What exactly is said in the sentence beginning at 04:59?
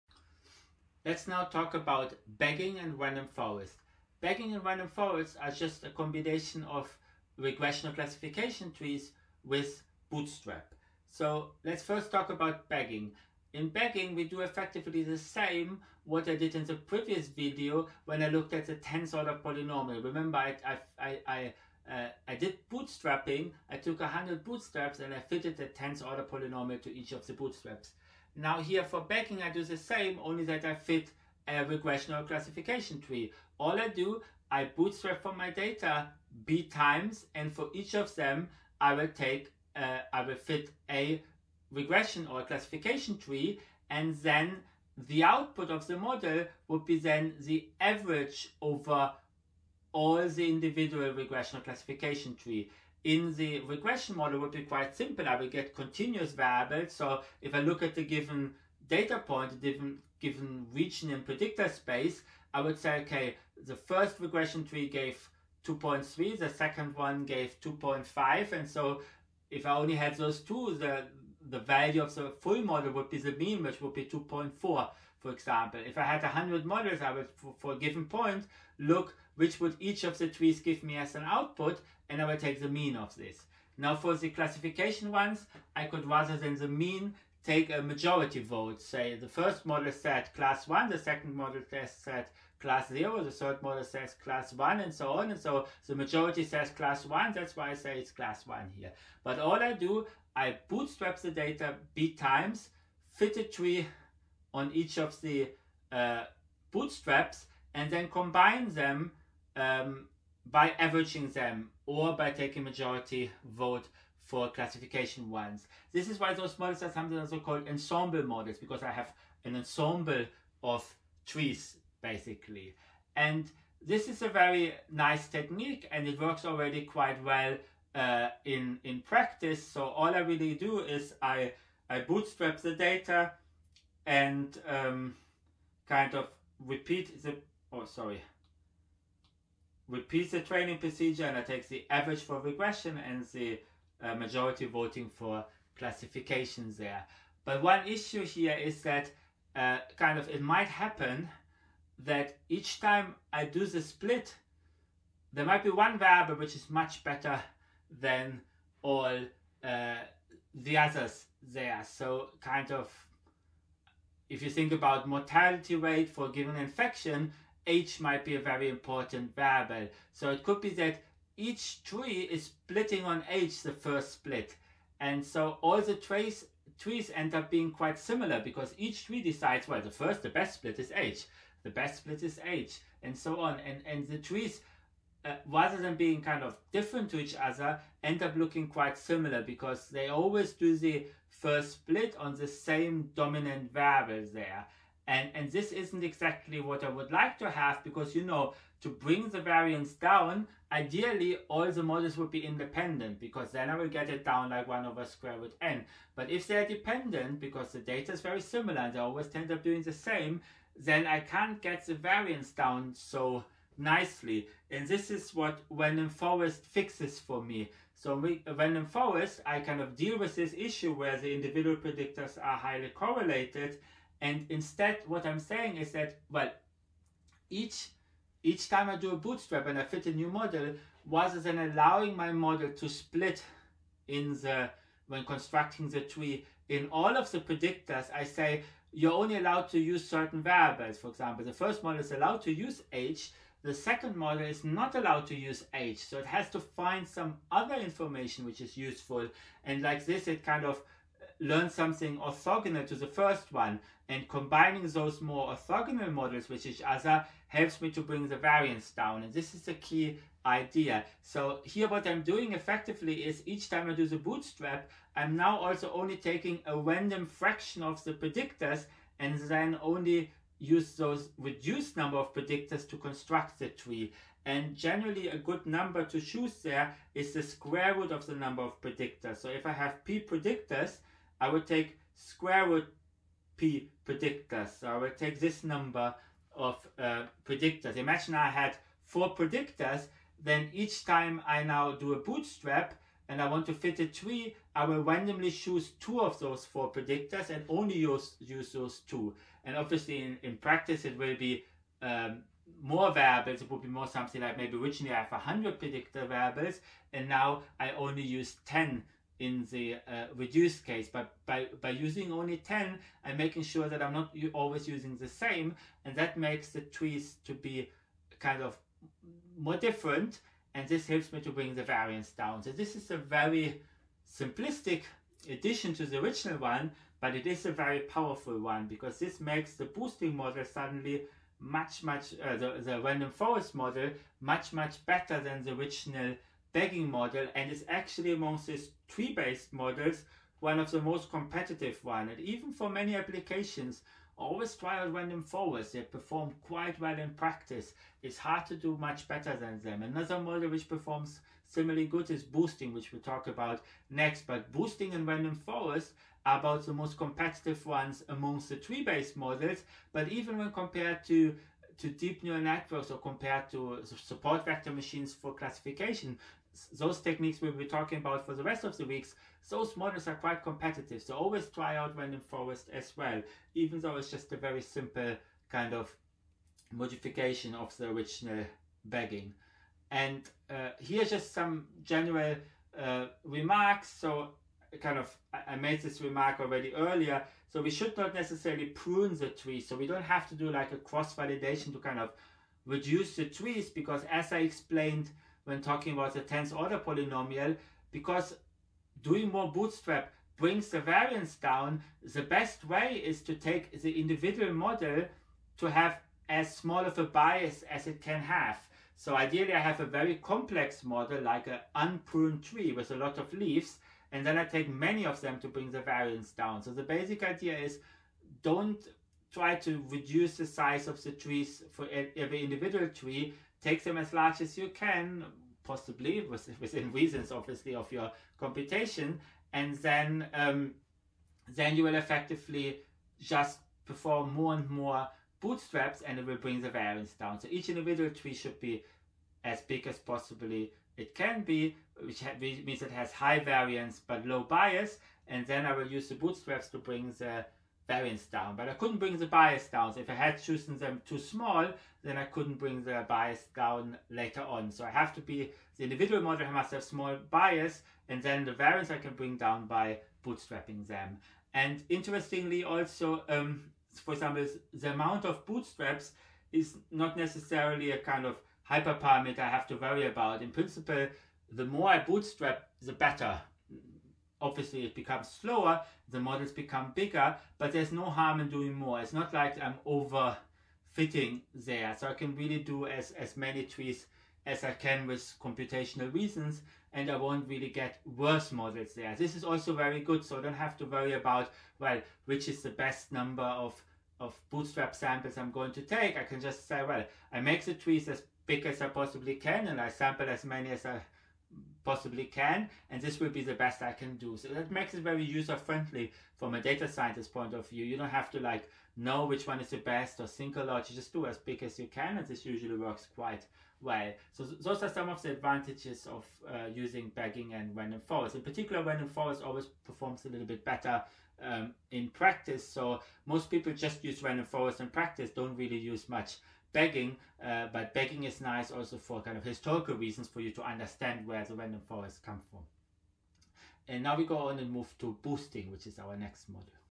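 And obviously, in, in practice, it will be um, more variables.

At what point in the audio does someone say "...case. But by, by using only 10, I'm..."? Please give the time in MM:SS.
05:10.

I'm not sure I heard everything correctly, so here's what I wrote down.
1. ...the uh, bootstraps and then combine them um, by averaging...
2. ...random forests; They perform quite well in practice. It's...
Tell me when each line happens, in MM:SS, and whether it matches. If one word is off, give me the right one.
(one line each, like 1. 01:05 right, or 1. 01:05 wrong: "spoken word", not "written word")
1. 01:45 right
2. 05:45 right.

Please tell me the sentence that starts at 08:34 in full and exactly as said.
So th those are some of the advantages of uh, using bagging and random forest.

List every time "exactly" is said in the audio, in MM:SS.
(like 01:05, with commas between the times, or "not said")
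03:16.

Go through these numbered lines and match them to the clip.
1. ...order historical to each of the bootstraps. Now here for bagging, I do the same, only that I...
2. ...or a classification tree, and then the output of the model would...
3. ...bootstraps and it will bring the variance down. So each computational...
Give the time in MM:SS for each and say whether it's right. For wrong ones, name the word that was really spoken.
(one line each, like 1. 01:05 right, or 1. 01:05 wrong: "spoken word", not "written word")
1. 00:26 wrong: "polynomial", not "historical"
2. 00:42 right
3. 07:15 wrong: "individual", not "computational".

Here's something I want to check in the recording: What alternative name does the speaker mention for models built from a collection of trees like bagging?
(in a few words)
ensemble models.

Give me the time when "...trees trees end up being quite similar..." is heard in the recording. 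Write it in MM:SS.
02:55.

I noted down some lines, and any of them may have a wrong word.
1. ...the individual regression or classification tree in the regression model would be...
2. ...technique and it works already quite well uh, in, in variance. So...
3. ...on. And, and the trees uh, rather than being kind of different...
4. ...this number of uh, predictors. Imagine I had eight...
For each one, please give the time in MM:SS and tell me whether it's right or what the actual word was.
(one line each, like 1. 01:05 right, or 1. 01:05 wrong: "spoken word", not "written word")
1. 00:50 right
2. 02:05 wrong: "practice", not "variance"
3. 03:03 right
4. 04:45 wrong: "four", not "eight".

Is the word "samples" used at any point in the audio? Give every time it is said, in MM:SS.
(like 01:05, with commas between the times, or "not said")
08:15, 08:20.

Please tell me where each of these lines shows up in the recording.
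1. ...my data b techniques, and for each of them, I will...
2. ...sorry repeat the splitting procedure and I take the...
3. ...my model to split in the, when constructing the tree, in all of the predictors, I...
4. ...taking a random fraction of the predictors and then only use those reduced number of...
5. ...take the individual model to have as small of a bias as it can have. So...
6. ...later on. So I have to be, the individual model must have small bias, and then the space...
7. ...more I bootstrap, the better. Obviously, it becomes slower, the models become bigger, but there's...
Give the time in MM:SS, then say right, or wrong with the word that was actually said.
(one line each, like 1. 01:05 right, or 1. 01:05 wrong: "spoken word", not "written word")
1. 00:35 wrong: "times", not "techniques"
2. 02:17 wrong: "training", not "splitting"
3. 03:52 right
4. 04:26 right
5. 06:43 right
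6. 07:34 wrong: "variance", not "space"
7. 07:51 right.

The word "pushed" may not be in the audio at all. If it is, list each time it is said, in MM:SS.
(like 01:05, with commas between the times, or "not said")
not said.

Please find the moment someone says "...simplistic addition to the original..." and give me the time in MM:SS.
05:24.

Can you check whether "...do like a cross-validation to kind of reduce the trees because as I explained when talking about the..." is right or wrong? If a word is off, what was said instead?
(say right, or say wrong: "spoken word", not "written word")
right.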